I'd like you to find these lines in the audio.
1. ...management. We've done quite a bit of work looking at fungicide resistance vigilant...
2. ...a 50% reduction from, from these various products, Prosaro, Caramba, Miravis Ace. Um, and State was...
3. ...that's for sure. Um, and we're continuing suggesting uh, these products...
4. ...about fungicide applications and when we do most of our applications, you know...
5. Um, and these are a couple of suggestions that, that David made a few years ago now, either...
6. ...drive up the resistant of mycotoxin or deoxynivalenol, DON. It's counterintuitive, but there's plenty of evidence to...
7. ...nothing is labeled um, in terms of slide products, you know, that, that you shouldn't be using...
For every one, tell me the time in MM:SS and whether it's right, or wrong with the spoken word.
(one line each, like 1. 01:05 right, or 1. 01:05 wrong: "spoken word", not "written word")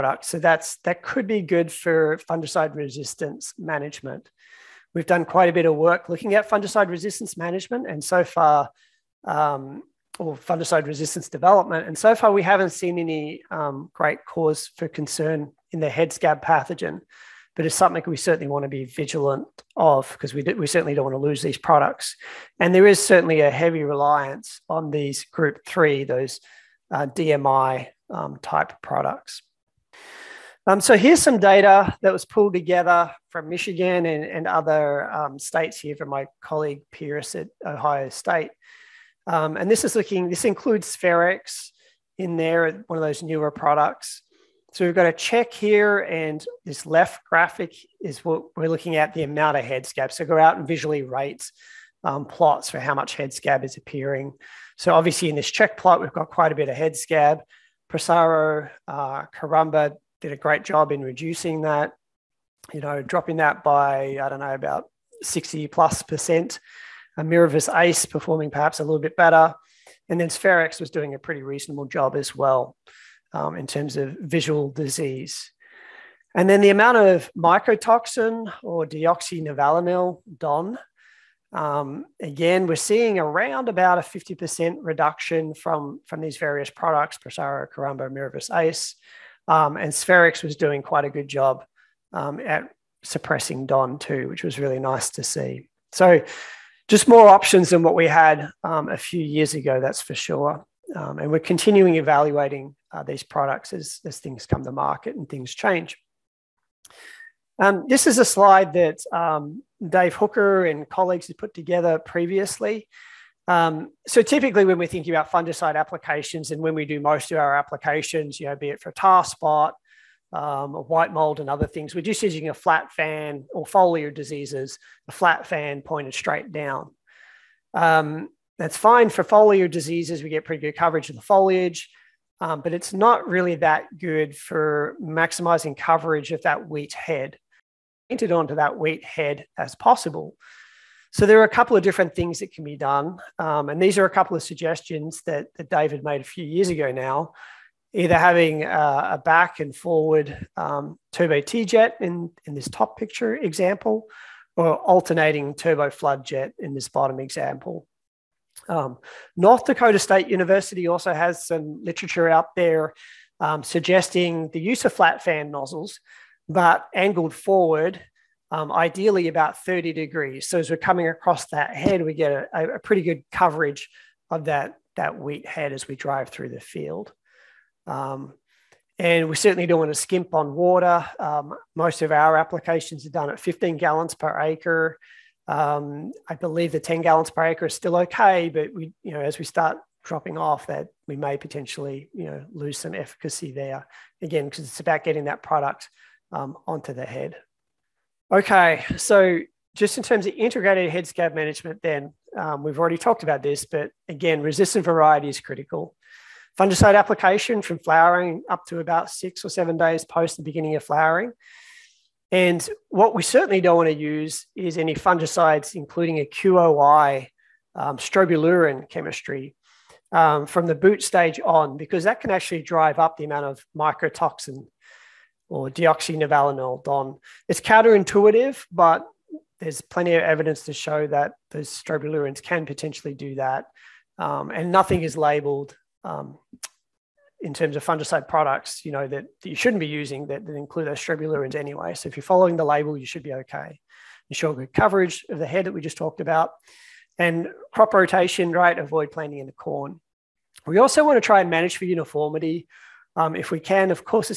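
1. 00:03 wrong: "management", not "vigilant"
2. 01:23 wrong: "Sphaerex", not "State"
3. 01:39 wrong: "evaluating", not "suggesting"
4. 01:55 right
5. 02:23 right
6. 03:42 wrong: "amount", not "resistant"
7. 03:54 wrong: "fungicide", not "slide".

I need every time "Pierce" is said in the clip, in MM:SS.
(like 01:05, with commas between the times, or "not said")
00:36.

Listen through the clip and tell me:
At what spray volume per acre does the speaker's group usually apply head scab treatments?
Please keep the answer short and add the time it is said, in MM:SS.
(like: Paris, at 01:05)
15 gallons per acre, at 03:03.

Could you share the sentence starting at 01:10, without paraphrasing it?
And then Sphaerex was doing a pretty reasonable job as well um, in terms of visual disease.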